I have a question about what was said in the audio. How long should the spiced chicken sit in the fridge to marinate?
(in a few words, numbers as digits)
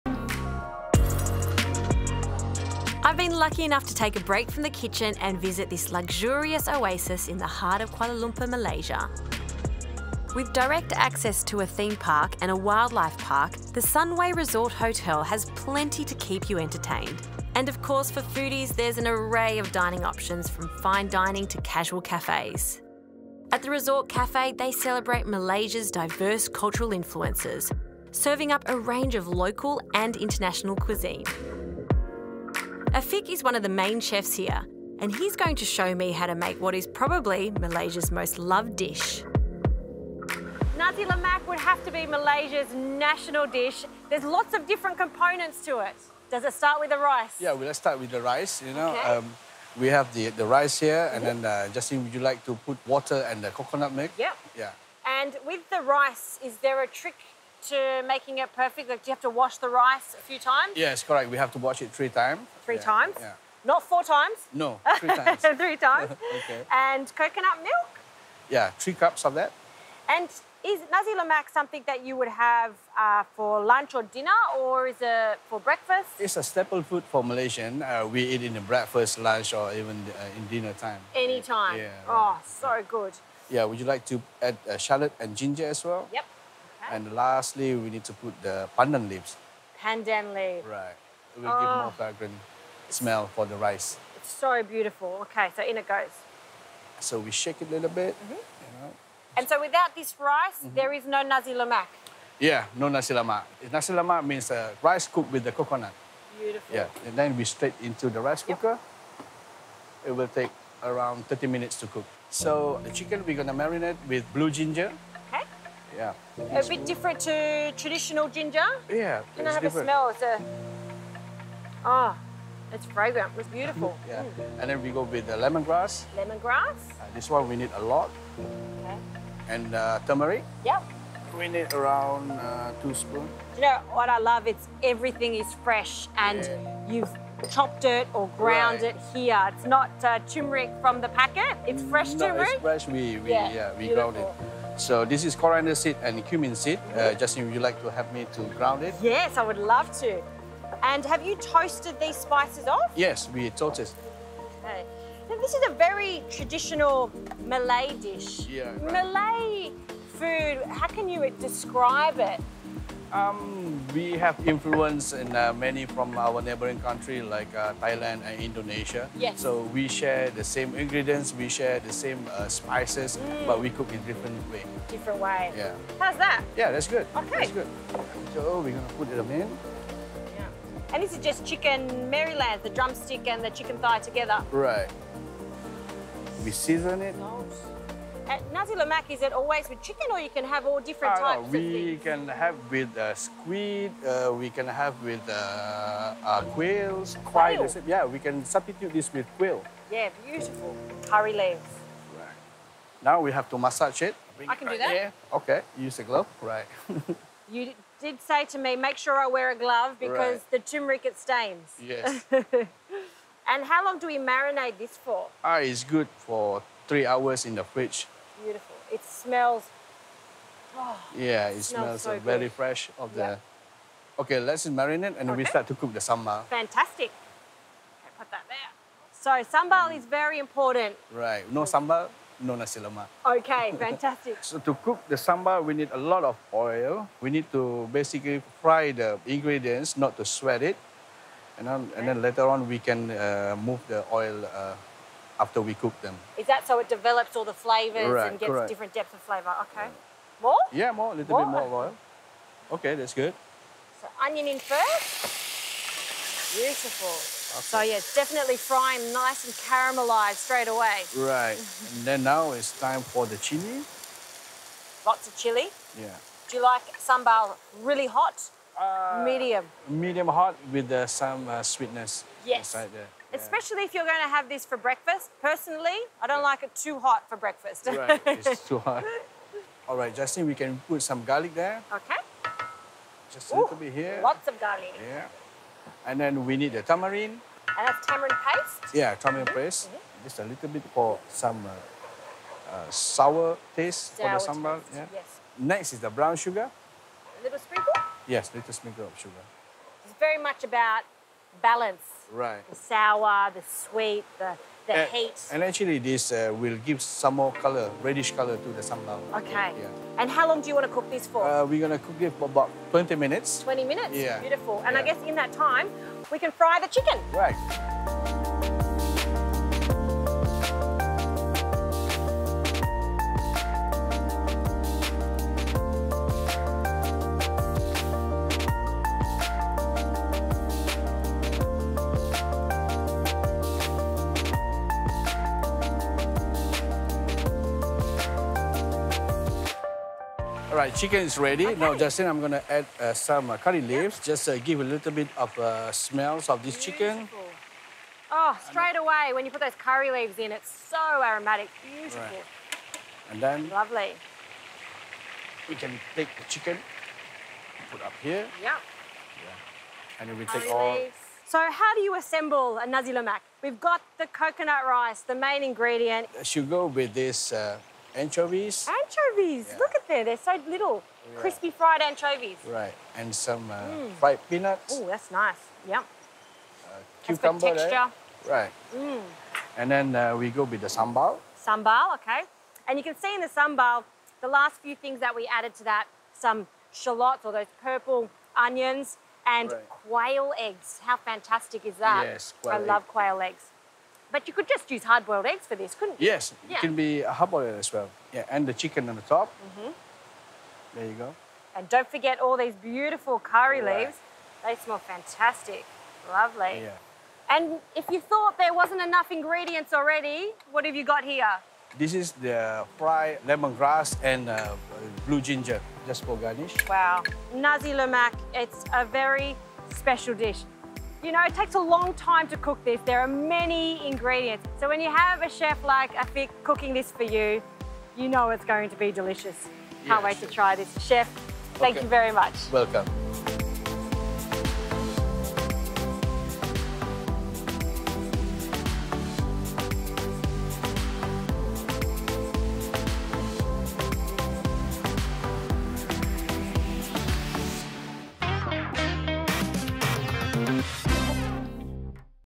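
3 hours.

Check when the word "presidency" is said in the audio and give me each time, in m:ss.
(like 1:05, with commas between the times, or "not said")
not said.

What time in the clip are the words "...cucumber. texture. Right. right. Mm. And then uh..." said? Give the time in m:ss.
6:17.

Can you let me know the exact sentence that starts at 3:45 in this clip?
we start to cook the sambal.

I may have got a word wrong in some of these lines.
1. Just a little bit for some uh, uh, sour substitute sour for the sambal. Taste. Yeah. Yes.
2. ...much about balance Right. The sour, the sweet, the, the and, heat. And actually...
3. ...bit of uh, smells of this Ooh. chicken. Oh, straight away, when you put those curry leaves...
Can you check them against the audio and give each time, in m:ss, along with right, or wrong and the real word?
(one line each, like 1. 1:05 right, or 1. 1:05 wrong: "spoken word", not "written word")
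1. 4:50 wrong: "taste", not "substitute"
2. 5:00 right
3. 5:45 wrong: "Beautiful", not "Ooh".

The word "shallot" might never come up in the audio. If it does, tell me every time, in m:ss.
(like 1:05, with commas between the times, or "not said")
1:24, 6:26.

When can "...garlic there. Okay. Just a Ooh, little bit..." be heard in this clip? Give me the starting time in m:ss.
4:41.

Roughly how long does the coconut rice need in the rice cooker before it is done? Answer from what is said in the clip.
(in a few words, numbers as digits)
30 minutes.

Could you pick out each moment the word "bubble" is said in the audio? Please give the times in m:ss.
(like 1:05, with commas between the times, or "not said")
not said.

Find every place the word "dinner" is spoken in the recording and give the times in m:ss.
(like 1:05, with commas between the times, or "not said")
1:14, 1:20.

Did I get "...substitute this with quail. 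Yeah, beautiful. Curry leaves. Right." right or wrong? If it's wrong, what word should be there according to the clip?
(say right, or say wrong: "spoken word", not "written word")
right.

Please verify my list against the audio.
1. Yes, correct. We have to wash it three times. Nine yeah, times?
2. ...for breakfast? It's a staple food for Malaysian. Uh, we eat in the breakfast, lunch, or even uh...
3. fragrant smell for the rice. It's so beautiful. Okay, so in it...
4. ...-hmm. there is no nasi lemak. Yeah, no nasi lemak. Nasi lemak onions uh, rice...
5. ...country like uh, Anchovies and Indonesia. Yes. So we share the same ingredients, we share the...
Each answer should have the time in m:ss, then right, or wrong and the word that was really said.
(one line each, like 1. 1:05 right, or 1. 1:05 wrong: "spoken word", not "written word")
1. 1:00 wrong: "Three", not "Nine"
2. 1:15 right
3. 1:31 right
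4. 1:40 wrong: "means", not "onions"
5. 2:46 wrong: "Thailand", not "Anchovies".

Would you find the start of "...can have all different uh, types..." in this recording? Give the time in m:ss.
3:10.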